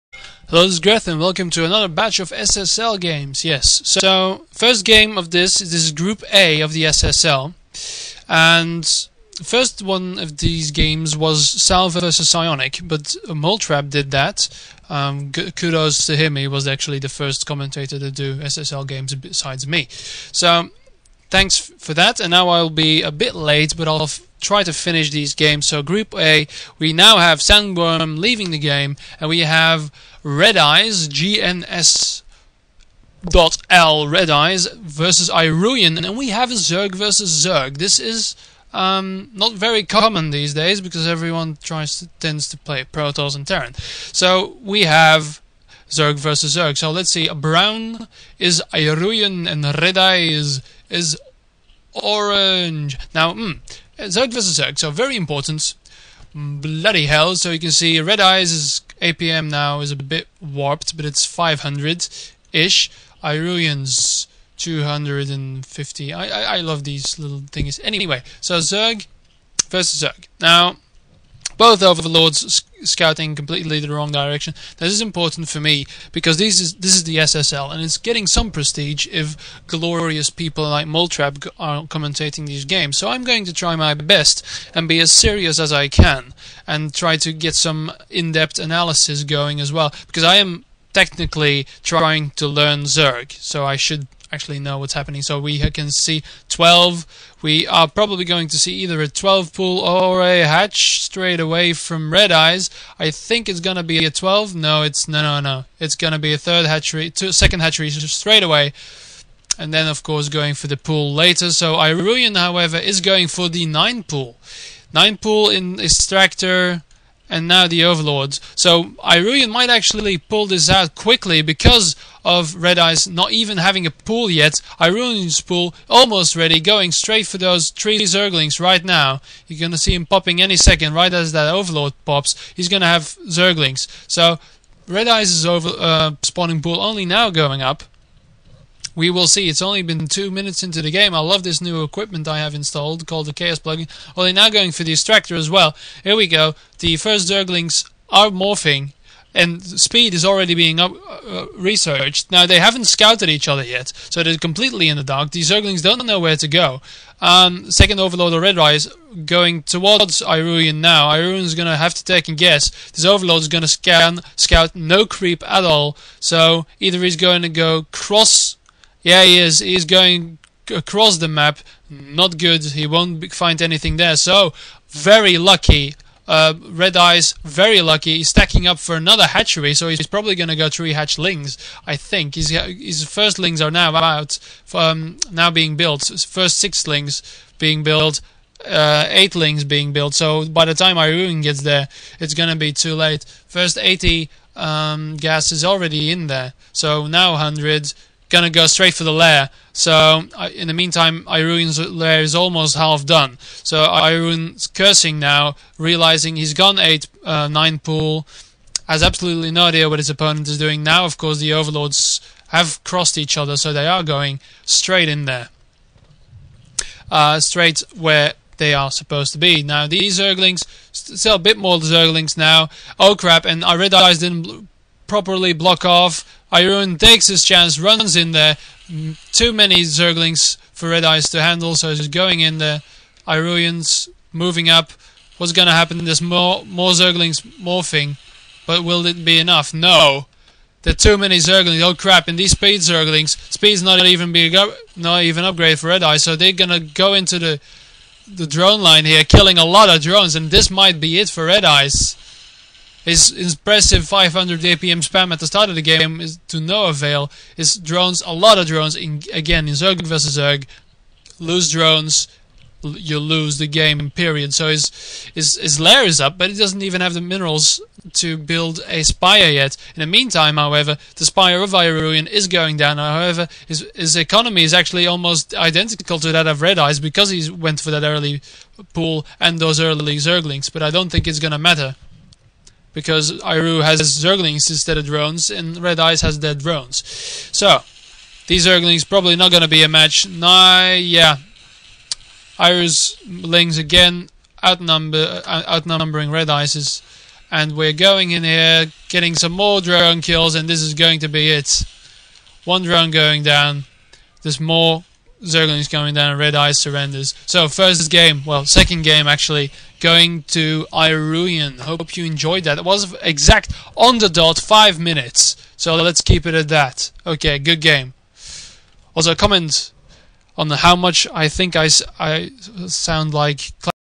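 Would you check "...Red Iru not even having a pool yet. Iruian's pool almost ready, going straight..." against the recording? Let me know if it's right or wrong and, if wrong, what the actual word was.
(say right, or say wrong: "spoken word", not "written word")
wrong: "Eyes", not "Iru".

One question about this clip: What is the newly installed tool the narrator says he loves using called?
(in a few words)
Chaos plugin.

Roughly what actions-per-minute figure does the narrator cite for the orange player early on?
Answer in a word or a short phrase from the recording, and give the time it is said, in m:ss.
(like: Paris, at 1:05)
500, at 1:01.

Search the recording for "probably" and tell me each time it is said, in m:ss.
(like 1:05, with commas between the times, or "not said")
1:37, 3:00, 4:49.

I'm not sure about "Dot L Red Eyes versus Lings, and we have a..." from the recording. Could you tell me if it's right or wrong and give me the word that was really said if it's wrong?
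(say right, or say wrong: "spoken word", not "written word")
wrong: "Iruian", not "Lings".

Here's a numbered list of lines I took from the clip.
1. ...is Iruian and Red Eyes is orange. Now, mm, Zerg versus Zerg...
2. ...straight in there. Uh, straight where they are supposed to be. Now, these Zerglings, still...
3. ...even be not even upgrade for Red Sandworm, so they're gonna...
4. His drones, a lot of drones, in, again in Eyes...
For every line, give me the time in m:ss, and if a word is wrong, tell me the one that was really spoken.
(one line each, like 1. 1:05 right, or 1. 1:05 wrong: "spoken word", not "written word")
1. 0:48 right
2. 3:34 right
3. 4:04 wrong: "Eye", not "Sandworm"
4. 4:17 wrong: "Zerg", not "Eyes".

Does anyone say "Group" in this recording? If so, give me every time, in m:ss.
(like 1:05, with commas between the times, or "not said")
0:05, 0:25.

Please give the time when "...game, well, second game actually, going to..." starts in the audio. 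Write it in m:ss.
5:08.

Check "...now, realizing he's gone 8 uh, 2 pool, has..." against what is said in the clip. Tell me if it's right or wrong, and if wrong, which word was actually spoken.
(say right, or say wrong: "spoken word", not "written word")
wrong: "9", not "2".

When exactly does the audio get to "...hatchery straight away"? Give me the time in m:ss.
1:47.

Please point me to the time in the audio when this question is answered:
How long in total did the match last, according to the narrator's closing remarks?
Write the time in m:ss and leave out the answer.
5:14.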